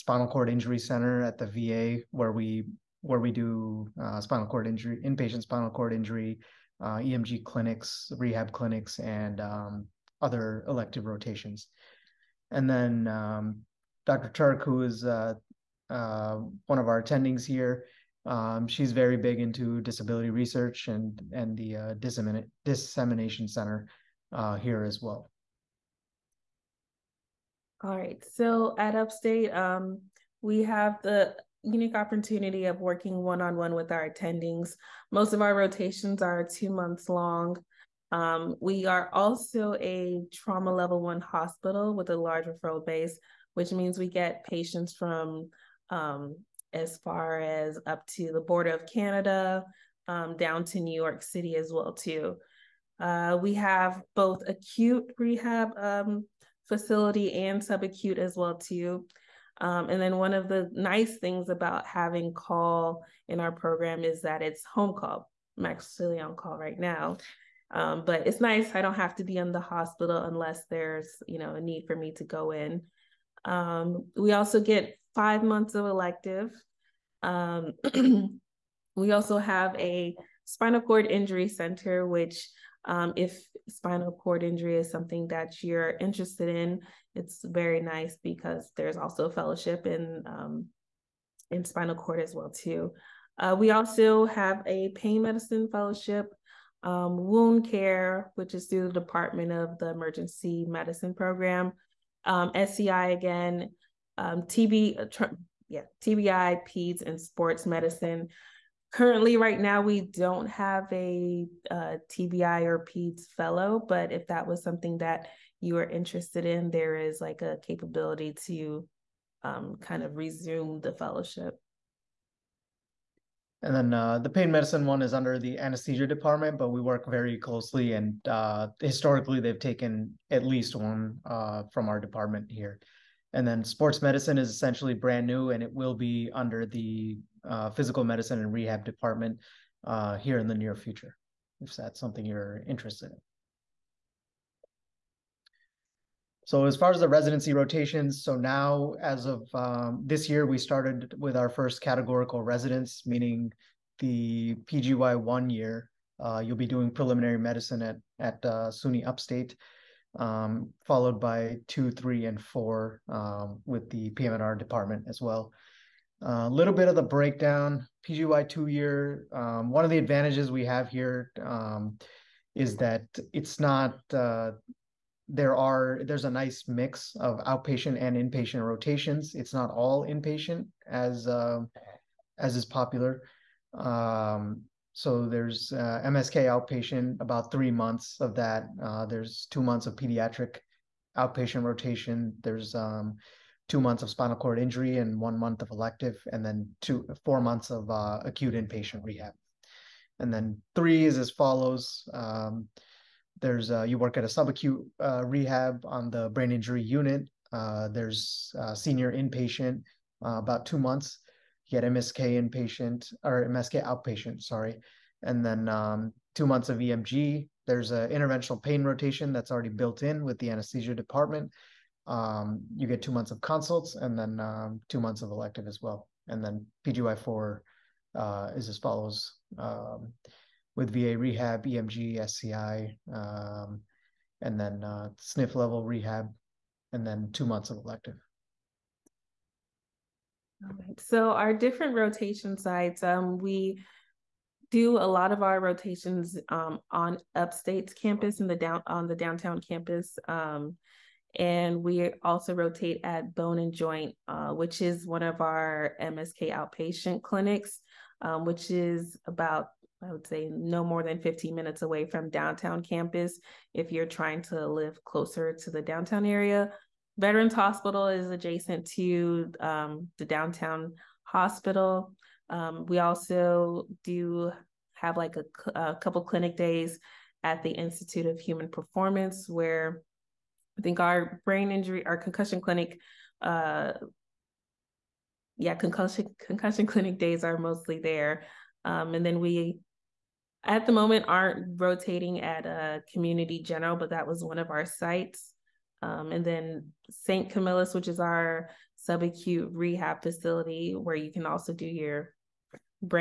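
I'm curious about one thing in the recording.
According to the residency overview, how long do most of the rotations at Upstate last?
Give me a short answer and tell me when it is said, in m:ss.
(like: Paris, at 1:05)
2 months, at 0:36.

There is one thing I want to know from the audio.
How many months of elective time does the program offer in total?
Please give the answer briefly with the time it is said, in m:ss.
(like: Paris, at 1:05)
5 months, at 1:15.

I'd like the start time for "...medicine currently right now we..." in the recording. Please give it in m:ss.
1:47.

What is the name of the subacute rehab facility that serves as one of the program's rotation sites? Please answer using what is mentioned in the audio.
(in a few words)
St. Camillus.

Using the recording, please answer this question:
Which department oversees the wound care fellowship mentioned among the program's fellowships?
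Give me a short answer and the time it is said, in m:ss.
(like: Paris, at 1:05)
Emergency Medicine, at 1:39.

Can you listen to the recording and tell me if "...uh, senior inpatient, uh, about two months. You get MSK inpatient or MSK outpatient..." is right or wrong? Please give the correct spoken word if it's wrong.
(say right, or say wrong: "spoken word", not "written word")
right.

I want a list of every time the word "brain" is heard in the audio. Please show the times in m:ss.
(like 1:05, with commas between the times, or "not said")
3:26, 4:41.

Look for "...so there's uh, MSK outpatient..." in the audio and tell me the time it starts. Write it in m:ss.
3:04.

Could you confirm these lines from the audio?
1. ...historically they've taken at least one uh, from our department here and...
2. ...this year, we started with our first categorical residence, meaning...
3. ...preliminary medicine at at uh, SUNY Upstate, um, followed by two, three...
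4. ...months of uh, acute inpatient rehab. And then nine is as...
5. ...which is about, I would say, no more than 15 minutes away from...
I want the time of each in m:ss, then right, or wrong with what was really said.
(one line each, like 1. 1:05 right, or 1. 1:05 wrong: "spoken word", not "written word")
1. 2:08 right
2. 2:30 right
3. 2:36 right
4. 3:17 wrong: "three", not "nine"
5. 4:18 right.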